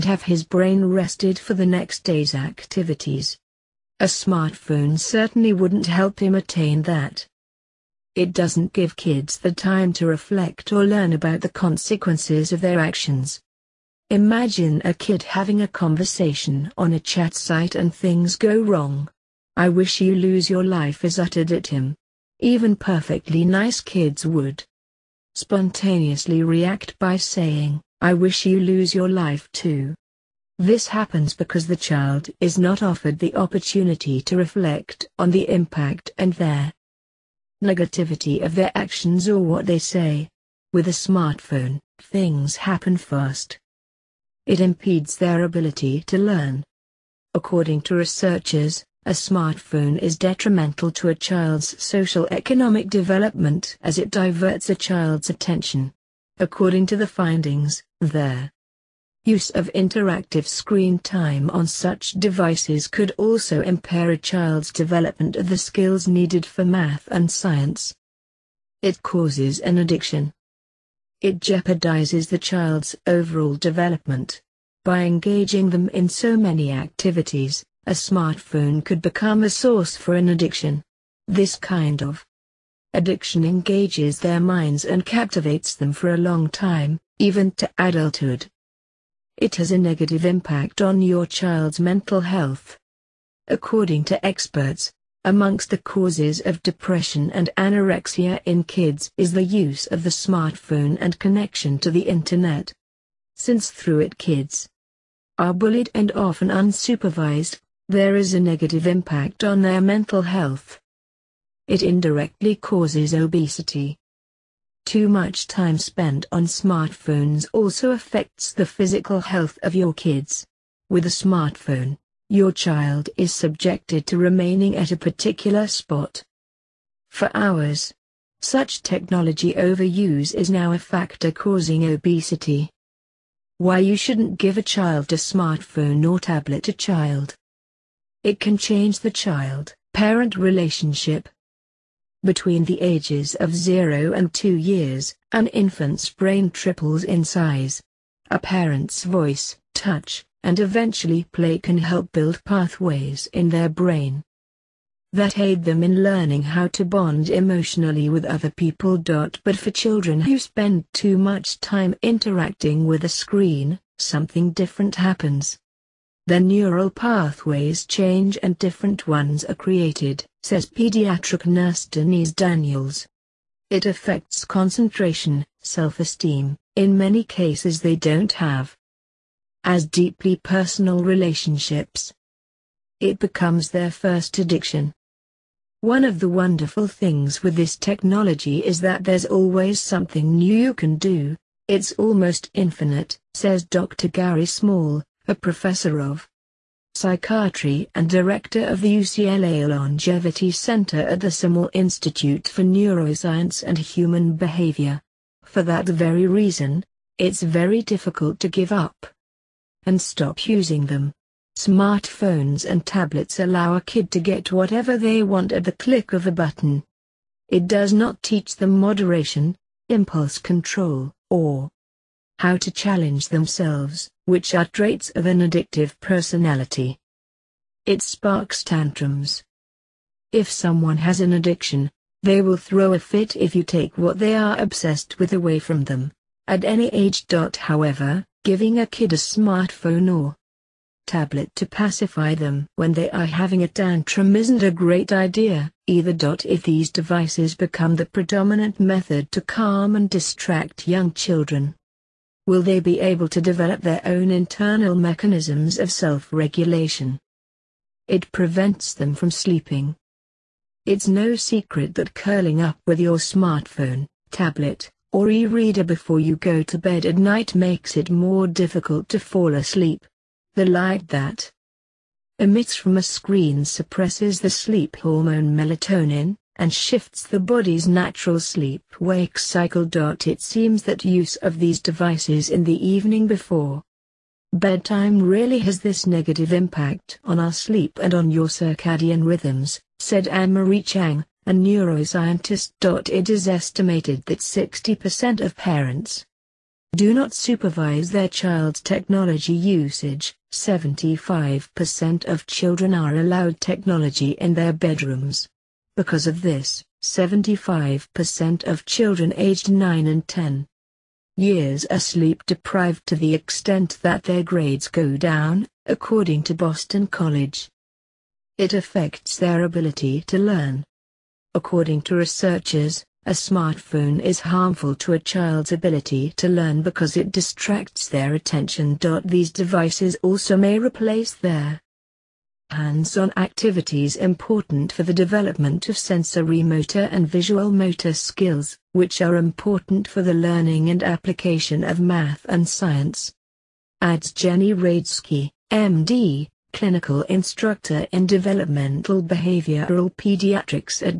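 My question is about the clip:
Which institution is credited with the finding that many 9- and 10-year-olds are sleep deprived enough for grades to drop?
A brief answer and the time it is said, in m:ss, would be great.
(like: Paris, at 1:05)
Boston College, at 5:16.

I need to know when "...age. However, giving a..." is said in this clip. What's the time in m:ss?
3:56.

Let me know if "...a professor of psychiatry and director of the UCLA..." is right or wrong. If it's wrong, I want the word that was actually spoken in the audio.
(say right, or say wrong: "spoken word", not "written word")
right.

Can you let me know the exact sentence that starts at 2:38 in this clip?
But for children who spend too much time interacting with a screen, something different happens.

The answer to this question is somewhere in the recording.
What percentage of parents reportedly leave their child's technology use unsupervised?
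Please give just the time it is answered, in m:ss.
4:54.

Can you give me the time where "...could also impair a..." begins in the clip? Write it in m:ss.
1:02.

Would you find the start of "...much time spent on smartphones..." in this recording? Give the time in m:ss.
1:55.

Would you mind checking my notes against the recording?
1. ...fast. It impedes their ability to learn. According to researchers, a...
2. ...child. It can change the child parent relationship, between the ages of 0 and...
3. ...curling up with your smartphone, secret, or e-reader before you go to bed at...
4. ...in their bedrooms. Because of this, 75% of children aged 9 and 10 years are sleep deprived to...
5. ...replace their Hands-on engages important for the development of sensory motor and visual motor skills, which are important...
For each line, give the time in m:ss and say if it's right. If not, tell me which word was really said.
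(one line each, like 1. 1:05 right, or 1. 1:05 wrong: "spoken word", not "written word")
1. 0:42 right
2. 2:16 right
3. 4:22 wrong: "tablet", not "secret"
4. 5:04 right
5. 5:30 wrong: "activities", not "engages".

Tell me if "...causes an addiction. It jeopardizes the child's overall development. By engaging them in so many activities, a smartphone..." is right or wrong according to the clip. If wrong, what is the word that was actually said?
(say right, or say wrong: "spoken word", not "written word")
right.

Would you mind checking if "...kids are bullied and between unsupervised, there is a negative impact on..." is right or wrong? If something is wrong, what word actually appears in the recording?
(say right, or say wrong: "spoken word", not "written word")
wrong: "often", not "between".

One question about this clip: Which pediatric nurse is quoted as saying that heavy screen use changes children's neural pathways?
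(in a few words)
Denise Daniels.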